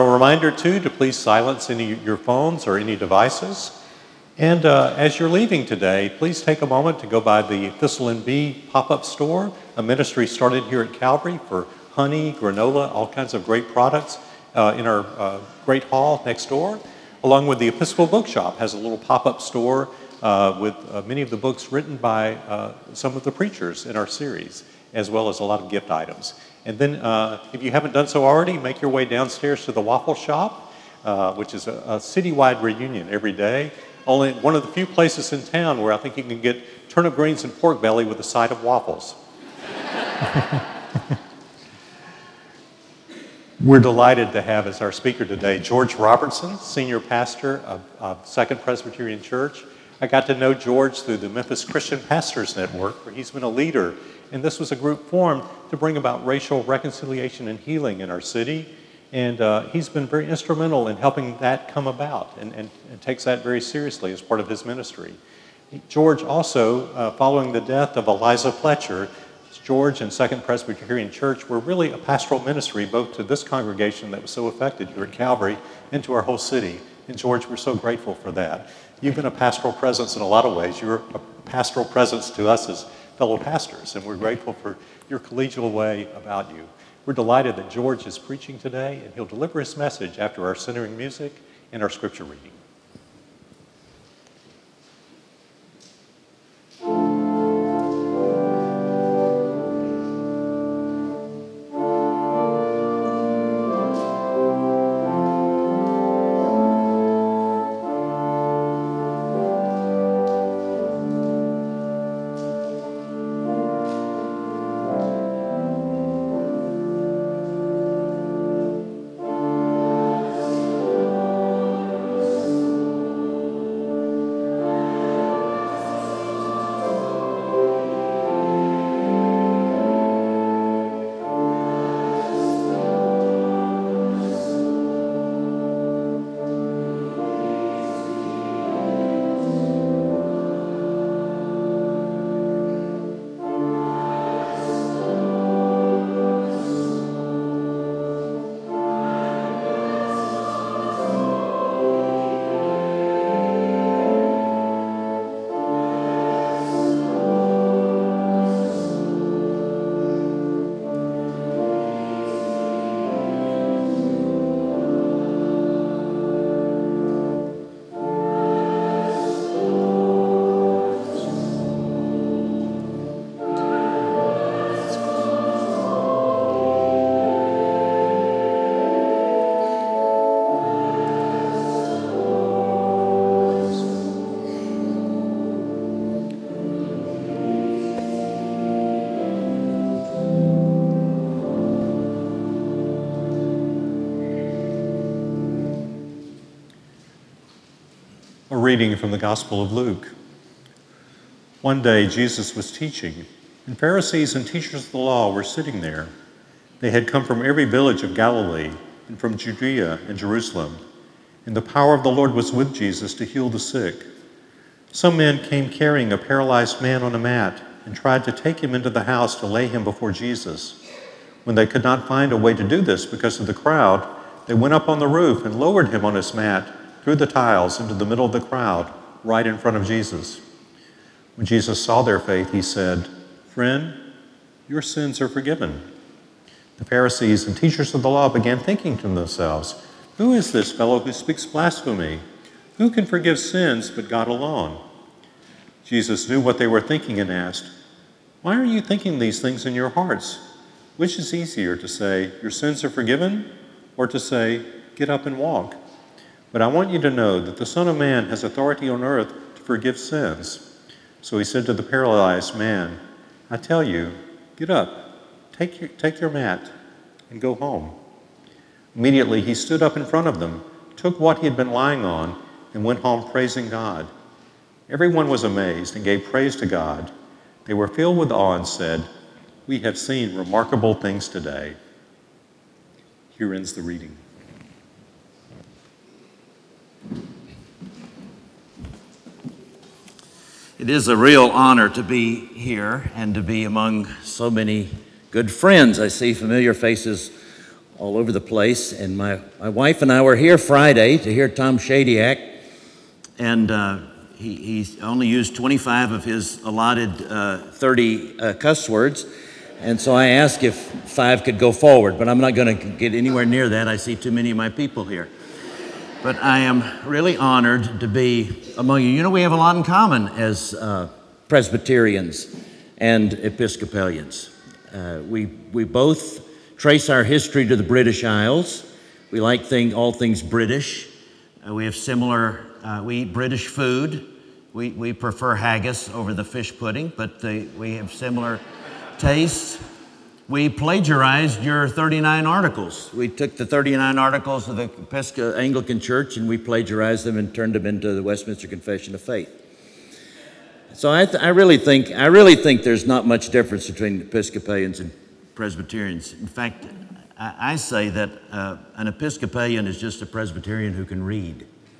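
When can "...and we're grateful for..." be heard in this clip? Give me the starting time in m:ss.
1:23.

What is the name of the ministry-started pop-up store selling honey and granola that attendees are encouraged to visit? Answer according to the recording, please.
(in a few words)
Thistle and Bee.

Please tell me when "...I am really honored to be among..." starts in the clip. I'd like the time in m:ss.
5:16.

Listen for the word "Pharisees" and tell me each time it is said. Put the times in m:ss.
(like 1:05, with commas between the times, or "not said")
3:23, 3:56.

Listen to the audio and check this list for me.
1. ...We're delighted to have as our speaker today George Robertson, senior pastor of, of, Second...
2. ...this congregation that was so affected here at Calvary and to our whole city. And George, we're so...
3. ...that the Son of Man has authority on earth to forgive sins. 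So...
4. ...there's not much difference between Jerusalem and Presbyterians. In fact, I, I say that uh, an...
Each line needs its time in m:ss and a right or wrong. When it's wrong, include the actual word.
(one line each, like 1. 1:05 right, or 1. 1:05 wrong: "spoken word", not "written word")
1. 0:43 right
2. 1:13 right
3. 4:17 right
4. 5:52 wrong: "Episcopalians", not "Jerusalem".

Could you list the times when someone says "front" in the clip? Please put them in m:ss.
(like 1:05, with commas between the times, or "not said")
3:49, 4:30.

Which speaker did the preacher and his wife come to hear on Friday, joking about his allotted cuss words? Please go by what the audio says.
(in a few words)
Tom Shadyac.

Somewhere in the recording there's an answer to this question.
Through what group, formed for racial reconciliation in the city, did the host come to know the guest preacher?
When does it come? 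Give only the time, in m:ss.
0:51.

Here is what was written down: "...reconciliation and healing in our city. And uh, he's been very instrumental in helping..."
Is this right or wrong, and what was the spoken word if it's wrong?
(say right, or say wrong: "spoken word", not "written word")
right.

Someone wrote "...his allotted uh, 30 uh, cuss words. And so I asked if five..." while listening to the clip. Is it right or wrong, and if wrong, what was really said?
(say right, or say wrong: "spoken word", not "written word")
right.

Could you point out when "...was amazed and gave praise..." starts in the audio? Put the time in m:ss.
4:35.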